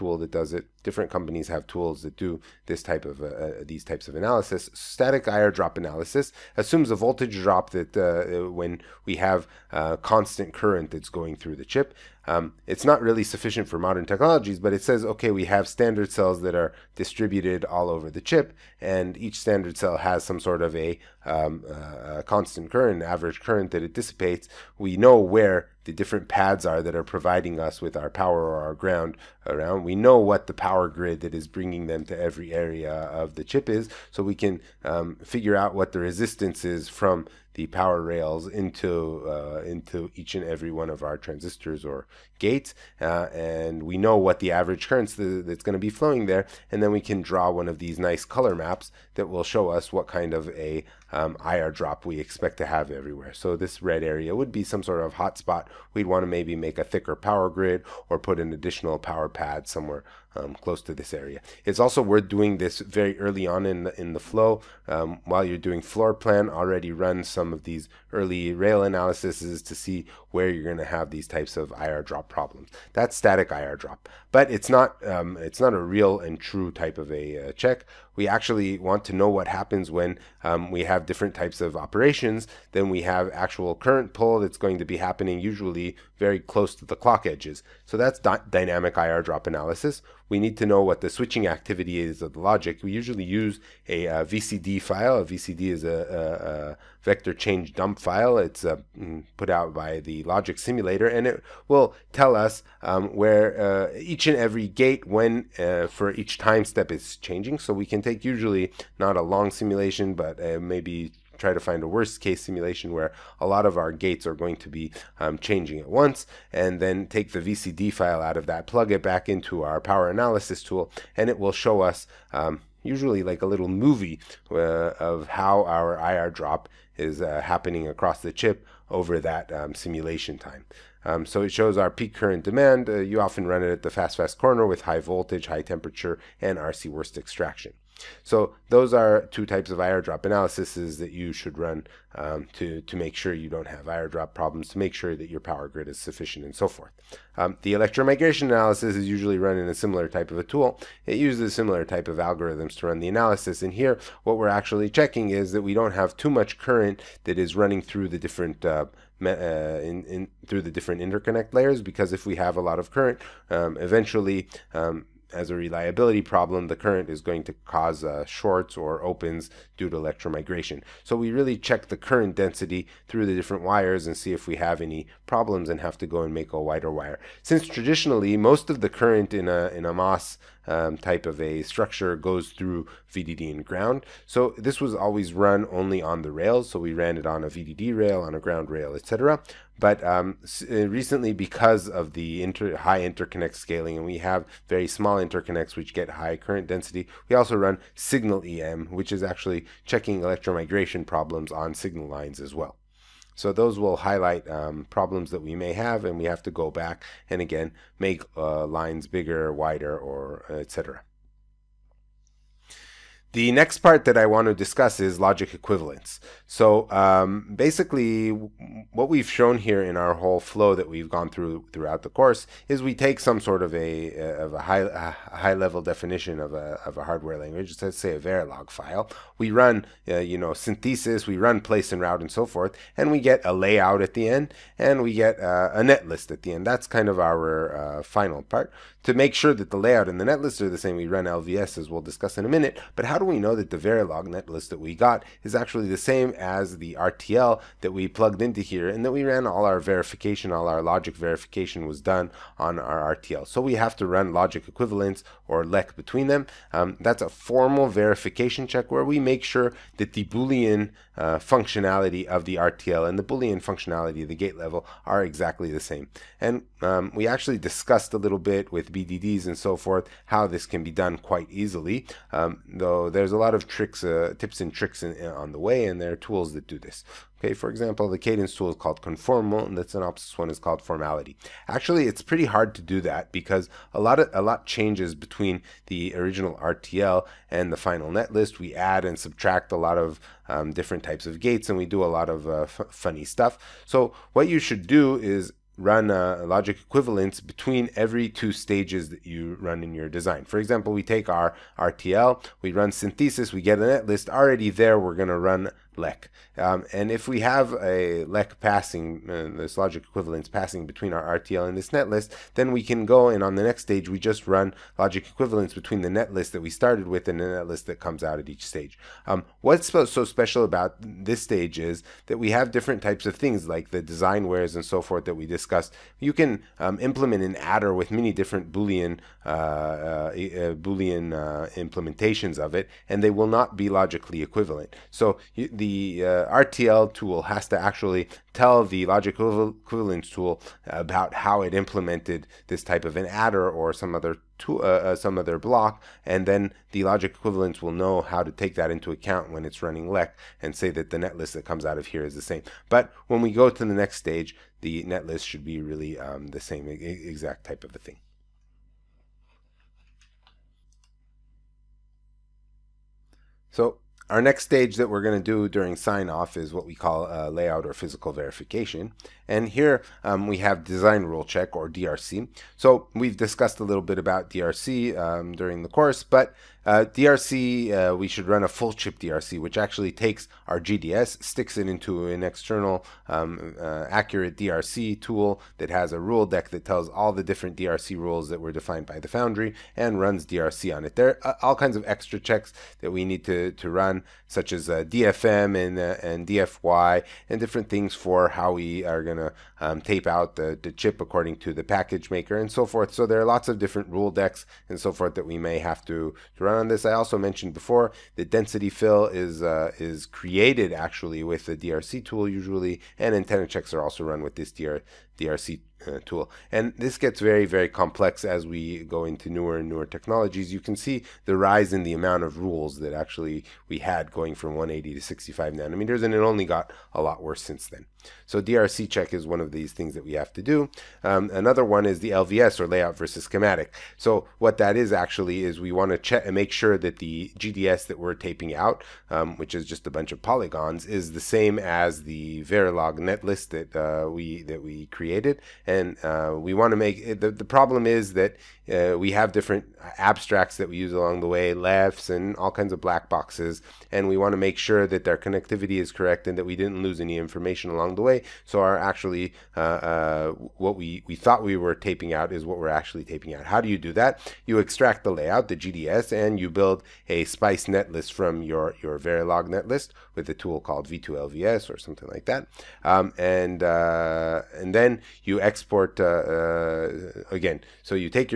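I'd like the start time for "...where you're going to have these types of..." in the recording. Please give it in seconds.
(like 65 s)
70 s.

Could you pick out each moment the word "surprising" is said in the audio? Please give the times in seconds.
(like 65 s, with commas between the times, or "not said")
not said.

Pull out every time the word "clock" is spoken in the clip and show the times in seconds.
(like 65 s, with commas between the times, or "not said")
86 s.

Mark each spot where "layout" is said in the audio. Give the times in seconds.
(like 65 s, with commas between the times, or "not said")
233 s, 239 s, 367 s, 432 s, 465 s.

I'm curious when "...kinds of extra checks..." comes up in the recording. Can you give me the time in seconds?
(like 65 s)
391 s.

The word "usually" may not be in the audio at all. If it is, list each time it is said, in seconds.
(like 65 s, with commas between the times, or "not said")
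85 s, 92 s, 108 s, 122 s, 149 s, 412 s.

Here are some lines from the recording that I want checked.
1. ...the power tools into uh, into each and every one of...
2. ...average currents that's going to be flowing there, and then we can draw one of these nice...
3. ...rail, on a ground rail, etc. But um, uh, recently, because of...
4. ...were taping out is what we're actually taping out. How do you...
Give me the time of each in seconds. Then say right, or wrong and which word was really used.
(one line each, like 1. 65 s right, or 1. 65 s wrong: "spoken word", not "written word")
1. 37 s wrong: "rails", not "tools"
2. 44 s right
3. 187 s right
4. 461 s right.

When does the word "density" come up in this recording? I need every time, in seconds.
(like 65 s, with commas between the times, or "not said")
172 s, 196 s, 408 s.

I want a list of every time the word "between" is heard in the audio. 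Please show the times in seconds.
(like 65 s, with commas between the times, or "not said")
255 s, 285 s, 297 s, 310 s, 315 s.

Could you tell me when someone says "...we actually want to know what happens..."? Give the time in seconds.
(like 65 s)
78 s.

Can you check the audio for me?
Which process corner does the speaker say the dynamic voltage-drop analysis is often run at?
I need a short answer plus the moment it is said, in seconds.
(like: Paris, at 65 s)
fast fast corner, at 133 s.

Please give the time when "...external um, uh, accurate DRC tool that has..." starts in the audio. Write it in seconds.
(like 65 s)
382 s.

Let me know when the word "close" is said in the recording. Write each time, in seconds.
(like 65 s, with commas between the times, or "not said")
60 s, 86 s.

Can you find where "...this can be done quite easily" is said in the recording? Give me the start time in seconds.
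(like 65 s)
270 s.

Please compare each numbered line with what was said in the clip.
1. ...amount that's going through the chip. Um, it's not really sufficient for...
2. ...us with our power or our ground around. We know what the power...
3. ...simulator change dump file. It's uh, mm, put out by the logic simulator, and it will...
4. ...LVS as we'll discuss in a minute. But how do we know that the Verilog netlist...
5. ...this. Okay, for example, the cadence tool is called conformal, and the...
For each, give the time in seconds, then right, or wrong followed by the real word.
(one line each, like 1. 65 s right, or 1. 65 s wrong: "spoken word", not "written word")
1. 10 s wrong: "current", not "amount"
2. 27 s right
3. 97 s wrong: "vector", not "simulator"
4. 241 s right
5. 276 s right.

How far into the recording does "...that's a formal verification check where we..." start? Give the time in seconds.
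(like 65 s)
256 s.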